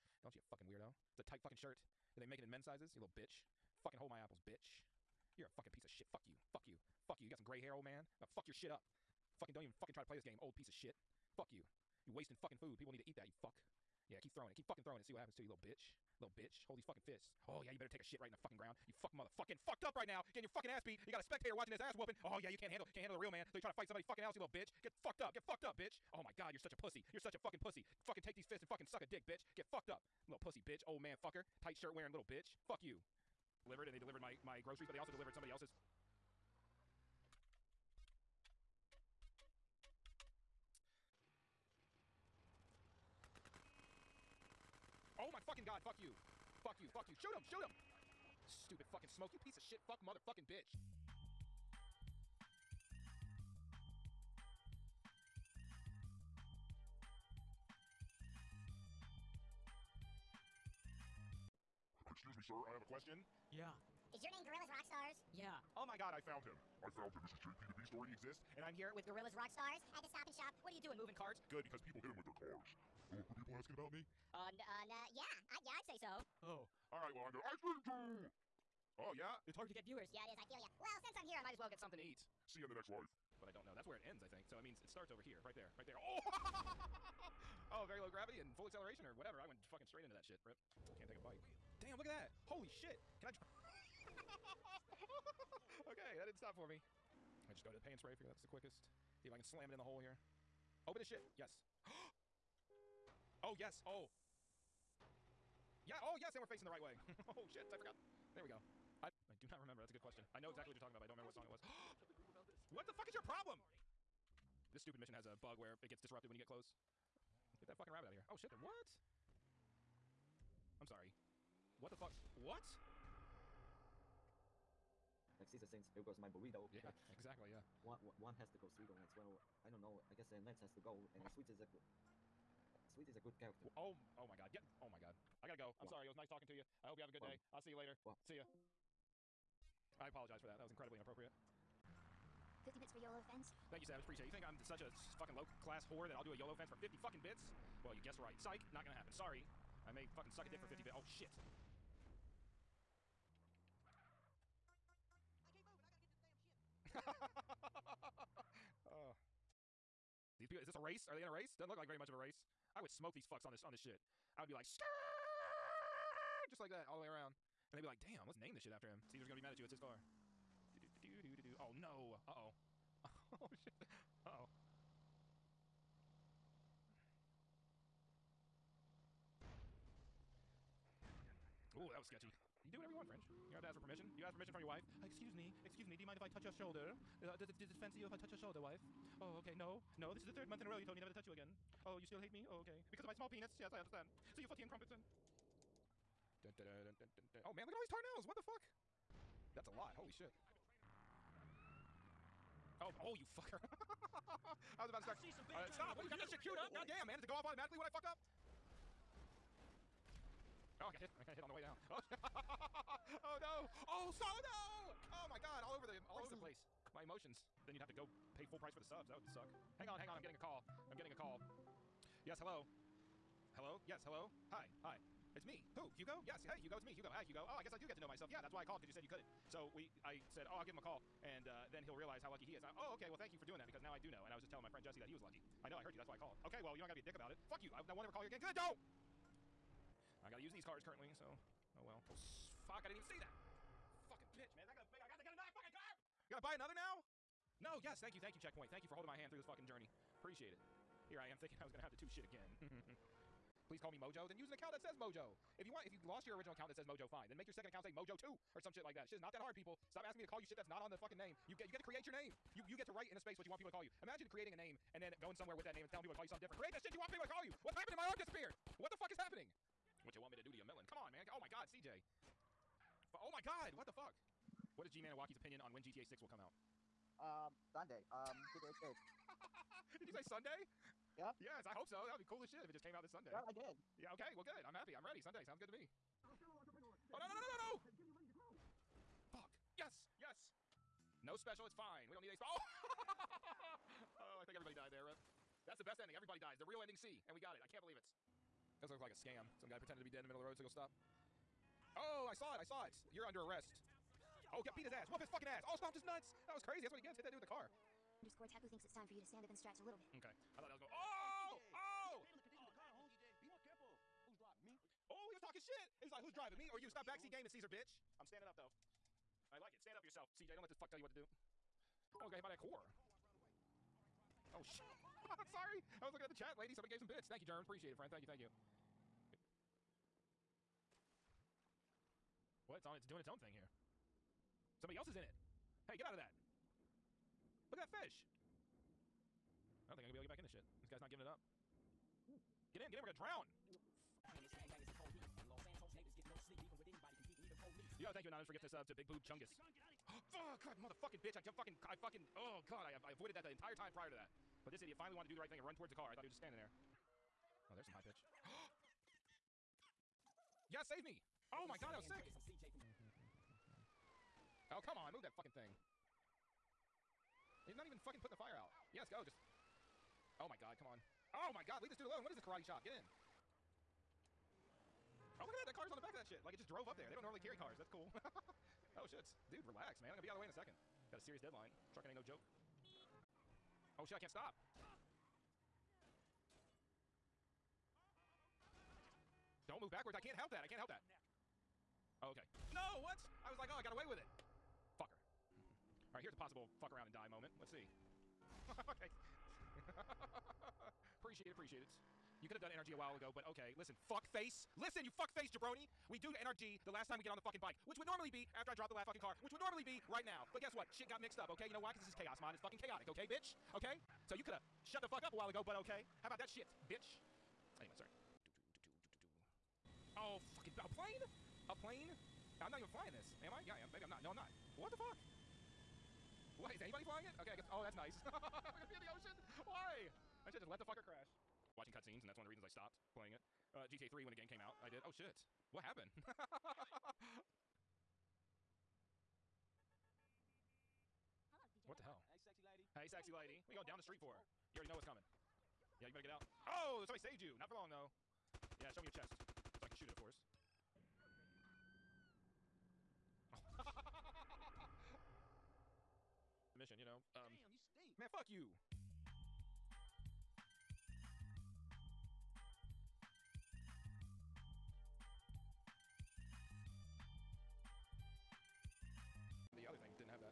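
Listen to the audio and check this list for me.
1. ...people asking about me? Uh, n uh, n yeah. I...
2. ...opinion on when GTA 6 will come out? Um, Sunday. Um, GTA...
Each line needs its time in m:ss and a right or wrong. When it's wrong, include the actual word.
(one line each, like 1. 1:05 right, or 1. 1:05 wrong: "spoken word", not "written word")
1. 1:13 right
2. 4:35 right.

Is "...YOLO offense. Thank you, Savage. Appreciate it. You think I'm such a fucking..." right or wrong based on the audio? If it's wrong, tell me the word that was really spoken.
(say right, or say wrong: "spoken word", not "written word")
right.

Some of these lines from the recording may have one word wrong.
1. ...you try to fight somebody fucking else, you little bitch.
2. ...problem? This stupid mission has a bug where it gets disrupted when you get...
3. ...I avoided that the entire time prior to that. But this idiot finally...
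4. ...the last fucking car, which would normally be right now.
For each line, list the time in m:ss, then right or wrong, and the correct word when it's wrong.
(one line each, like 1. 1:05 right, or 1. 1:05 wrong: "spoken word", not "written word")
1. 0:23 right
2. 1:53 right
3. 5:53 right
4. 6:48 right.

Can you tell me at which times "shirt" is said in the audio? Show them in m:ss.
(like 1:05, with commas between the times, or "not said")
0:01, 0:31.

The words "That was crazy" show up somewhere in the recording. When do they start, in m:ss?
5:06.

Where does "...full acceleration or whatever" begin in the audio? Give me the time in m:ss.
1:28.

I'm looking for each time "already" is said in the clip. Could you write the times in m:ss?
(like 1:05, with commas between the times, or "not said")
1:07, 7:24.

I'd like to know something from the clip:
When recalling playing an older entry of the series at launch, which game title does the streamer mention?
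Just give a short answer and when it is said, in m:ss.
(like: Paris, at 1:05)
GTA 3, at 7:13.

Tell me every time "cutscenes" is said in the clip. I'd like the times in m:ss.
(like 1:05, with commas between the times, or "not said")
7:11.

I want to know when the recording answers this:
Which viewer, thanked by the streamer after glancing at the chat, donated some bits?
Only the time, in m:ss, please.
5:27.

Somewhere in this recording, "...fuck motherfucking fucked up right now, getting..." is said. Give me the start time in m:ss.
0:18.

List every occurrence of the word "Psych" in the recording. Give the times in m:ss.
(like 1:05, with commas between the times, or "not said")
2:28.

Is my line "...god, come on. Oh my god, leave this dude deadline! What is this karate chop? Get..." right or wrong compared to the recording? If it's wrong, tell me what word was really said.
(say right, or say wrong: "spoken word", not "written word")
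wrong: "alone", not "deadline".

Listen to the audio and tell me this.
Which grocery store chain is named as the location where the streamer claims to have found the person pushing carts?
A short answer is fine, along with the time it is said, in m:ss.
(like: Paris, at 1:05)
Stop and Shop, at 1:10.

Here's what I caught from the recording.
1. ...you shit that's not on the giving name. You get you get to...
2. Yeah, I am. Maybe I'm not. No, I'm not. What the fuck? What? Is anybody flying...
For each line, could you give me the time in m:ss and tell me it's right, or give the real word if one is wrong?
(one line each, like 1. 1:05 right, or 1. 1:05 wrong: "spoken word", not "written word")
1. 4:20 wrong: "fucking", not "giving"
2. 7:03 right.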